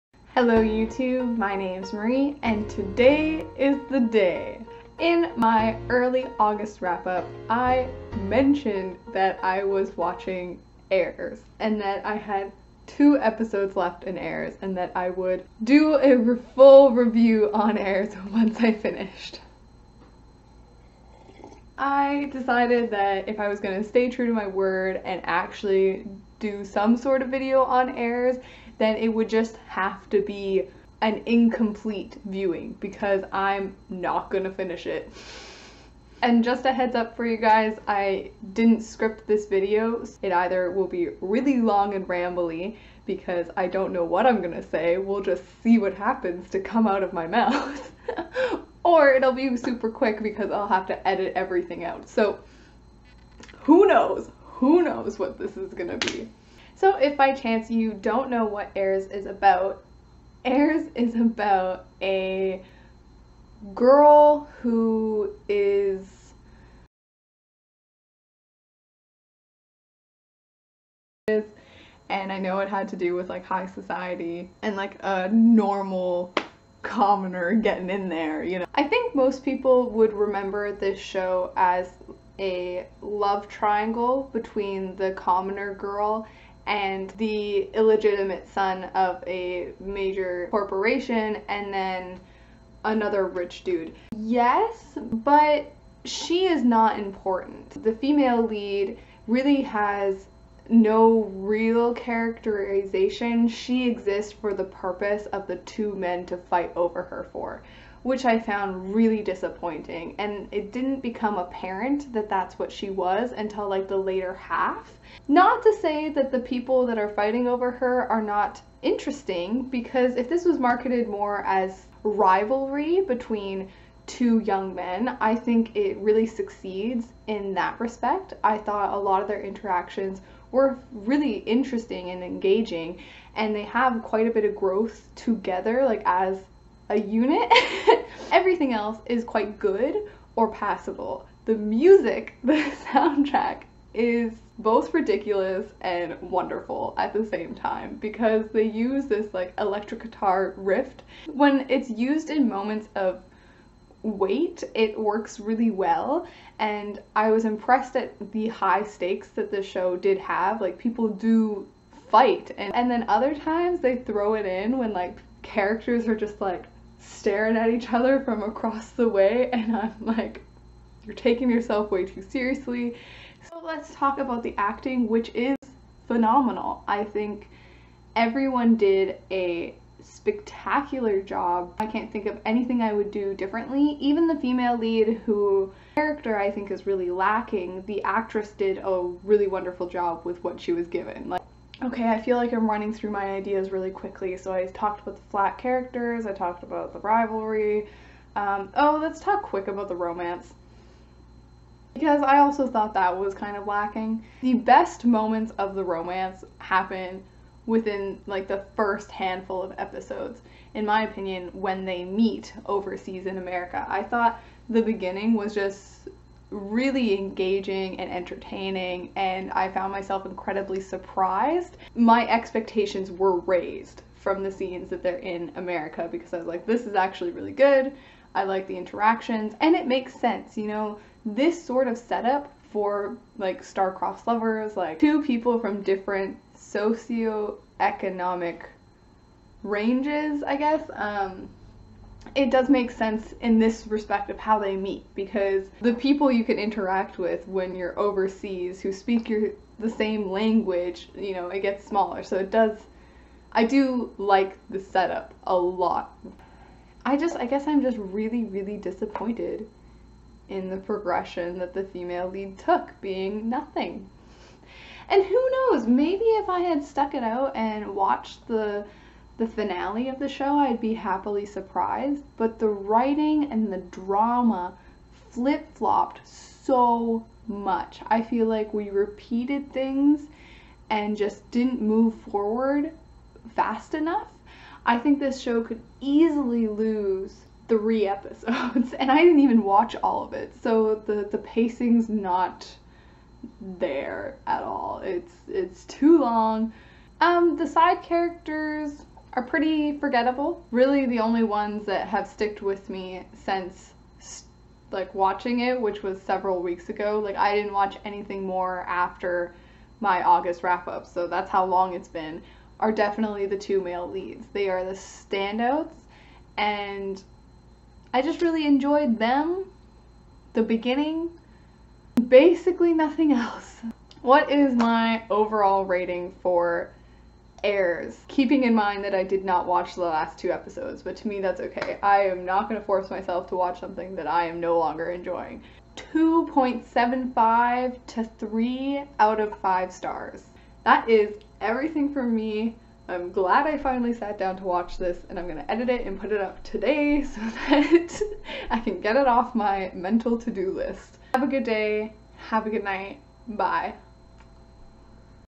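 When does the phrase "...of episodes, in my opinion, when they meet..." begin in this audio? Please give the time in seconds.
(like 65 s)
209 s.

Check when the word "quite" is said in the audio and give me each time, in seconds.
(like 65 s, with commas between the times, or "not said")
134 s, 139 s.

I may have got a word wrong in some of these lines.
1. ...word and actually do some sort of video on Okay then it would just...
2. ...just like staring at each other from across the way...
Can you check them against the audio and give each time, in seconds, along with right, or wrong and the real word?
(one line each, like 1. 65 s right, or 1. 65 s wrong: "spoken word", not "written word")
1. 24 s wrong: "Heirs", not "Okay"
2. 166 s right.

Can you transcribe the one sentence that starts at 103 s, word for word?
She exists for the purpose of the two men to fight over her for which I found really disappointing.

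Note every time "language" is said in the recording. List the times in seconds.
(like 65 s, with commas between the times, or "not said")
250 s.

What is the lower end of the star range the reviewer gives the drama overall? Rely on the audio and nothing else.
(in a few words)
2.75.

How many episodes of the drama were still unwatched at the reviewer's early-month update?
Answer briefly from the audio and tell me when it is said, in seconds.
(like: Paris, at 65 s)
2, at 12 s.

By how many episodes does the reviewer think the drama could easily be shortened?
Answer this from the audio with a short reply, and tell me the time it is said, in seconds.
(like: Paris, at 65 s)
3, at 287 s.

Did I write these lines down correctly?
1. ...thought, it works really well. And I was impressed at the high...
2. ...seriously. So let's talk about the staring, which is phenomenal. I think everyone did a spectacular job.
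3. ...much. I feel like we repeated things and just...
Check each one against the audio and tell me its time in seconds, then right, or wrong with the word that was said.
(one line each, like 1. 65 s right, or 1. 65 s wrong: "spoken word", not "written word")
1. 154 s wrong: "weight", not "thought"
2. 172 s wrong: "acting", not "staring"
3. 277 s right.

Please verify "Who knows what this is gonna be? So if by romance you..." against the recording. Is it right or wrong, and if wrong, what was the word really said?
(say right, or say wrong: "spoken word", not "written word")
wrong: "chance", not "romance".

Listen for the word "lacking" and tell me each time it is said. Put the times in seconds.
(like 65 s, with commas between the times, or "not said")
187 s, 203 s.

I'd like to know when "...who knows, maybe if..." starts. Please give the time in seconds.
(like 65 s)
265 s.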